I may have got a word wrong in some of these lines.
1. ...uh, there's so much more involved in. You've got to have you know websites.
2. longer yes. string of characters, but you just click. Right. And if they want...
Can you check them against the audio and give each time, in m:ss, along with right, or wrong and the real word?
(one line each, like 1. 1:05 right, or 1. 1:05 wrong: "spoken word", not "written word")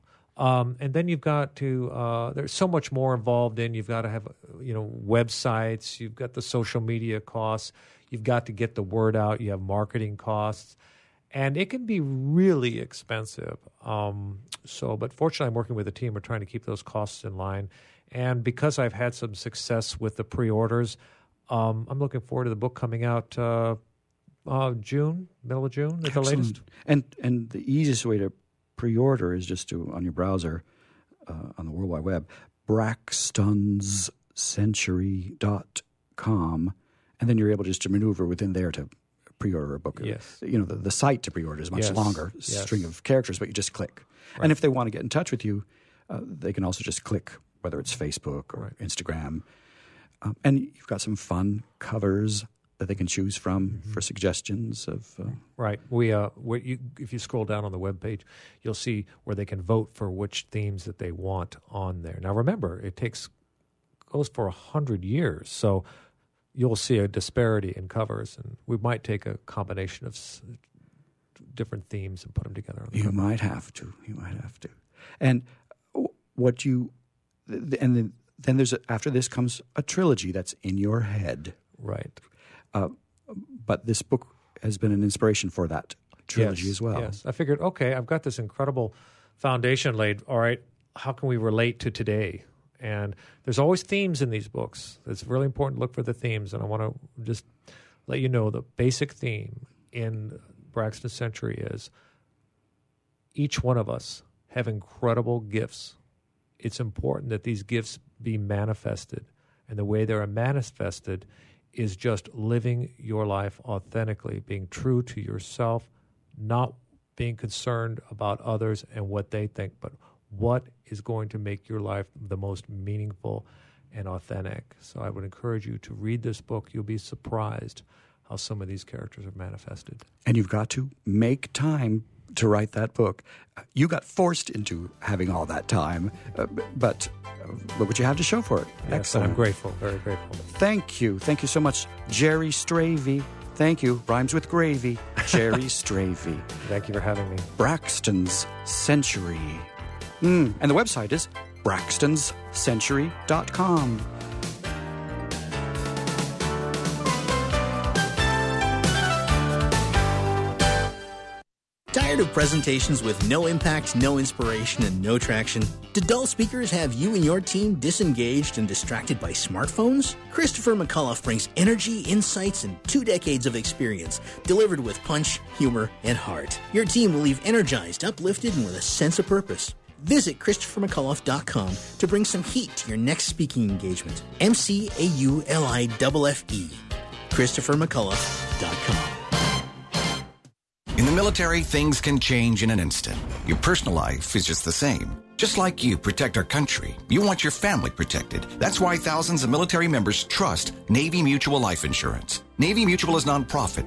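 1. 0:01 right
2. 0:41 right.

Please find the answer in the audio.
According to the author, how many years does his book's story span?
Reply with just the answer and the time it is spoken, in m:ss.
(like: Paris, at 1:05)
100, at 1:04.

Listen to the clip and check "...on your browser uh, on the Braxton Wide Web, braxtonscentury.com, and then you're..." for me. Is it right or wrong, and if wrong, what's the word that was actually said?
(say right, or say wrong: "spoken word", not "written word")
wrong: "World", not "Braxton".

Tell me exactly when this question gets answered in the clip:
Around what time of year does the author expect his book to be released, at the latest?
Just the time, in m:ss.
0:25.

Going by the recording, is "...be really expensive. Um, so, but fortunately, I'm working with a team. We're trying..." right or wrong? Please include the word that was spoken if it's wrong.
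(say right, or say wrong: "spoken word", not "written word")
right.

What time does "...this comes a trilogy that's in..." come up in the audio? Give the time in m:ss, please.
1:19.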